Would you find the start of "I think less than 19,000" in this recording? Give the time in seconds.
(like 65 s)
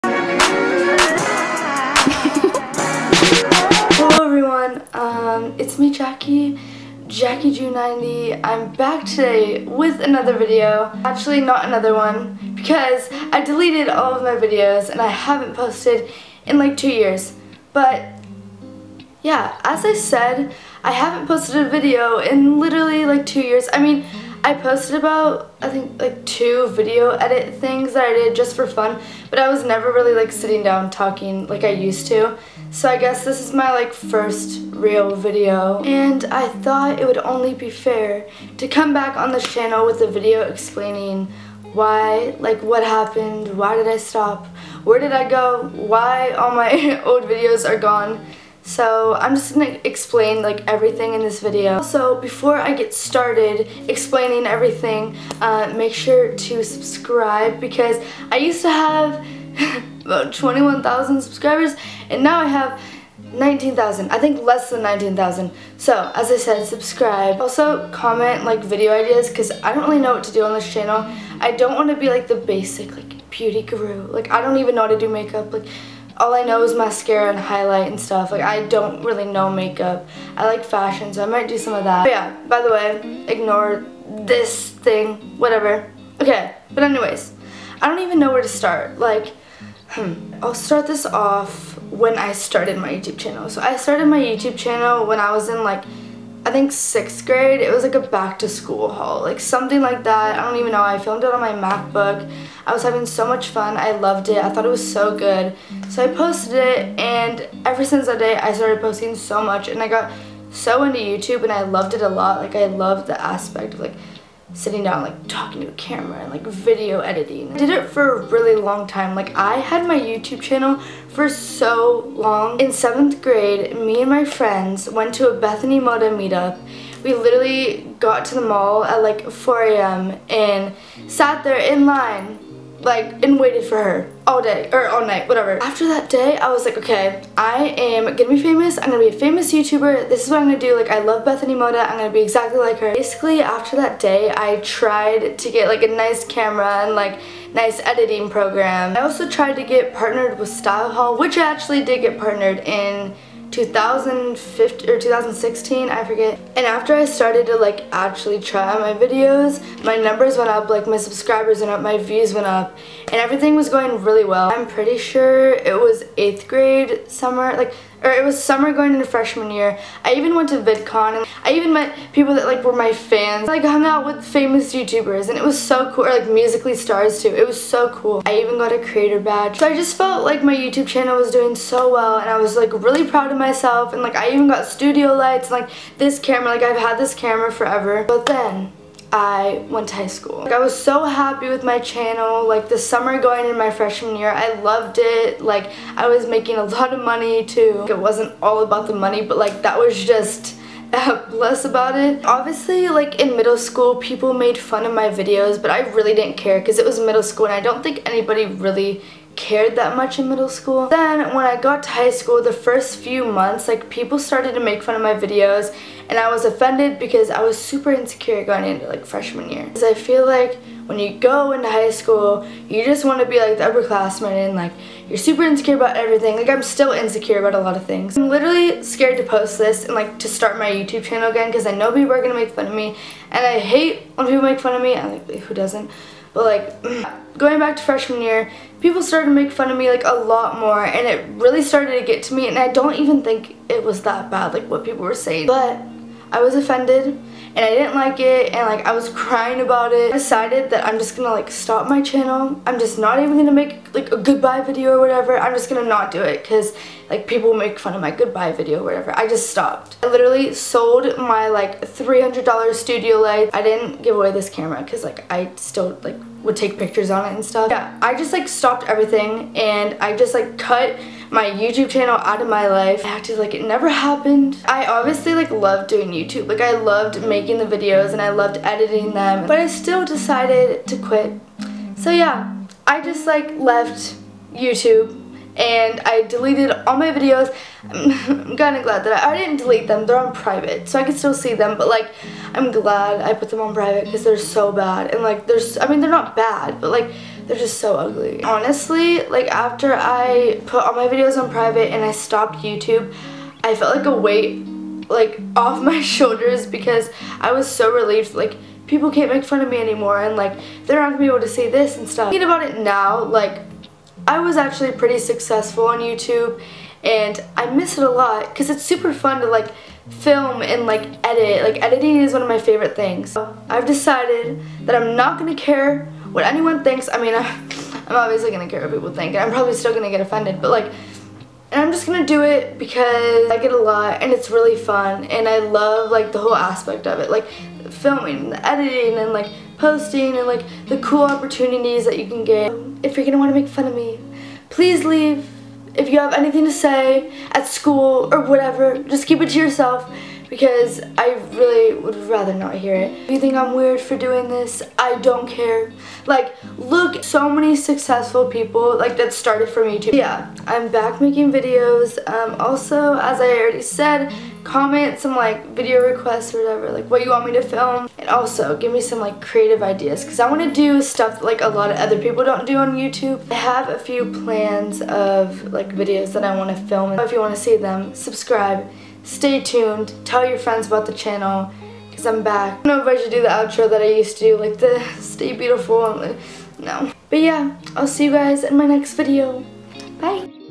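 64 s.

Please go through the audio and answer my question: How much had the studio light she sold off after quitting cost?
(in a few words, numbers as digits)
$300.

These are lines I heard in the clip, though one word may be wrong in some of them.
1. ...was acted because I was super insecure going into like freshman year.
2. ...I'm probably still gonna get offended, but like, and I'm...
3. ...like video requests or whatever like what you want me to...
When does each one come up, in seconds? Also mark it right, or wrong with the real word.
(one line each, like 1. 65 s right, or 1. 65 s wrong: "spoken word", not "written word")
1. 216 s wrong: "offended", not "acted"
2. 329 s right
3. 365 s right.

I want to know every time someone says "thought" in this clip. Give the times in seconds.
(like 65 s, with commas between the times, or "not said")
36 s, 104 s.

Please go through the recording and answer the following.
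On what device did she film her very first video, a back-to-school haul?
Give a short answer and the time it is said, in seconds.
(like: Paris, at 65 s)
MacBook, at 101 s.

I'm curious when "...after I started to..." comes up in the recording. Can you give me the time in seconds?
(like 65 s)
156 s.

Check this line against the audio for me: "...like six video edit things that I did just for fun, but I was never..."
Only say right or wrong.
wrong.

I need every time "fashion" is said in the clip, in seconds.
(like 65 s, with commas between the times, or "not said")
80 s.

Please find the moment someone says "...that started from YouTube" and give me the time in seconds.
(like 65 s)
359 s.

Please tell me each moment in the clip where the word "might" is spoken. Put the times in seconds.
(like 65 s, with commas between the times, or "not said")
81 s.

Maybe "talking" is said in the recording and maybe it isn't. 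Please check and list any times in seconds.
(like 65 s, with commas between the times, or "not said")
30 s, 115 s.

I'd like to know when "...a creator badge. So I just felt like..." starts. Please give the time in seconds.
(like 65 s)
178 s.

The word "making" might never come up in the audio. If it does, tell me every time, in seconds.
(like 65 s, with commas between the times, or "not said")
196 s, 277 s, 361 s.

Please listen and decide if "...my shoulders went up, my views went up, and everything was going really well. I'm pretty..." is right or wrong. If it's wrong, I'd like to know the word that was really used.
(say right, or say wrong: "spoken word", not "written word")
wrong: "subscribers", not "shoulders".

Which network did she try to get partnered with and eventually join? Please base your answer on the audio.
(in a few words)
StyleHaul.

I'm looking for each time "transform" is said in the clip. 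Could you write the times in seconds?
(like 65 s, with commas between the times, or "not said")
not said.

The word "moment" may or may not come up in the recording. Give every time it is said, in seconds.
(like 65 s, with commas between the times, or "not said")
not said.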